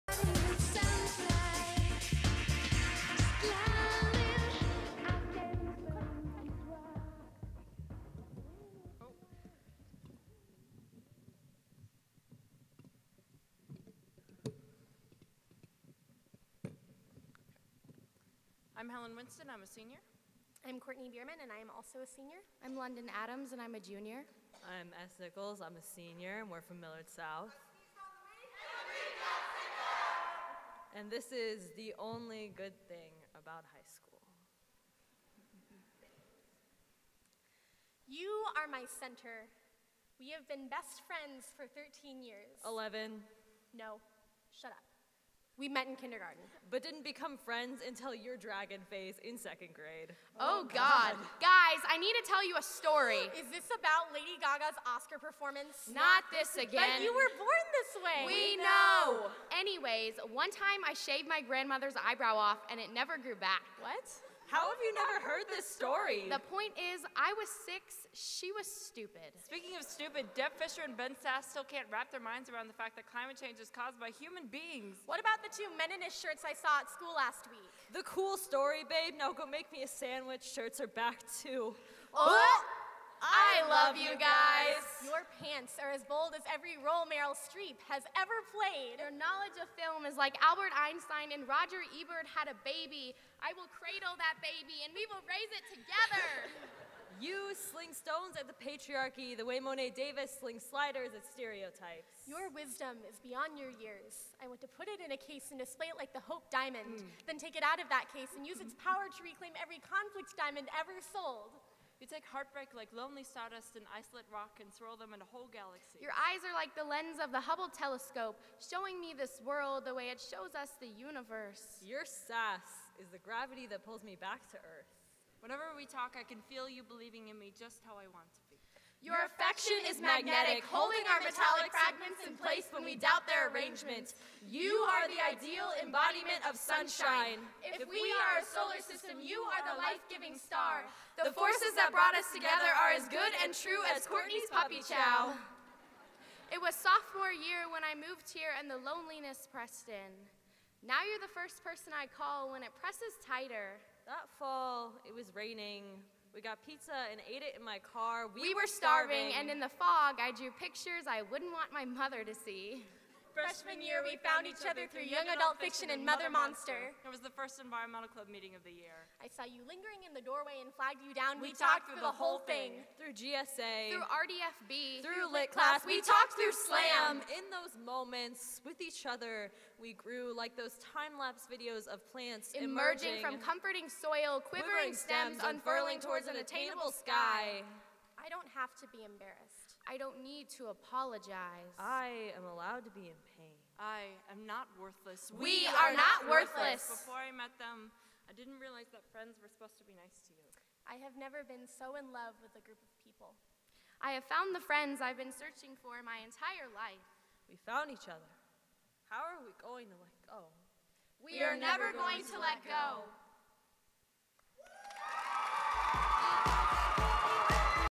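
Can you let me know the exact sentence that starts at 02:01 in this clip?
Your sass is the gravity that pulls me back to Earth.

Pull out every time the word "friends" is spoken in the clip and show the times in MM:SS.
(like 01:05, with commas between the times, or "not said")
00:41, 00:47, 03:19, 03:24.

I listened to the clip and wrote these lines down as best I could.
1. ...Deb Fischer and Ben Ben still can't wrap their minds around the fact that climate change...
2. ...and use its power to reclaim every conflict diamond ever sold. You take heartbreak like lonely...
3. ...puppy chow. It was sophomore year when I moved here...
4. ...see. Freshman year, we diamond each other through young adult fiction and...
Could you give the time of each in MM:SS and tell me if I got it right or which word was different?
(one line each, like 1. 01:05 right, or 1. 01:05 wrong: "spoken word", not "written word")
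1. 01:10 wrong: "Sasse", not "Ben"
2. 01:48 right
3. 02:24 right
4. 02:42 wrong: "found", not "diamond".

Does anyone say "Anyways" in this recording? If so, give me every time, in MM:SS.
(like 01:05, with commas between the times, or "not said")
00:59.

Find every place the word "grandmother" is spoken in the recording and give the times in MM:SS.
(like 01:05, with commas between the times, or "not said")
01:01.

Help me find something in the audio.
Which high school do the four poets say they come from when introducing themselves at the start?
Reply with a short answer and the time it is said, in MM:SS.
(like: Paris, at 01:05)
Millard South, at 00:26.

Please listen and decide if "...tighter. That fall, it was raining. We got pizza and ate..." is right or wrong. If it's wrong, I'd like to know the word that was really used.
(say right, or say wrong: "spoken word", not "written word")
right.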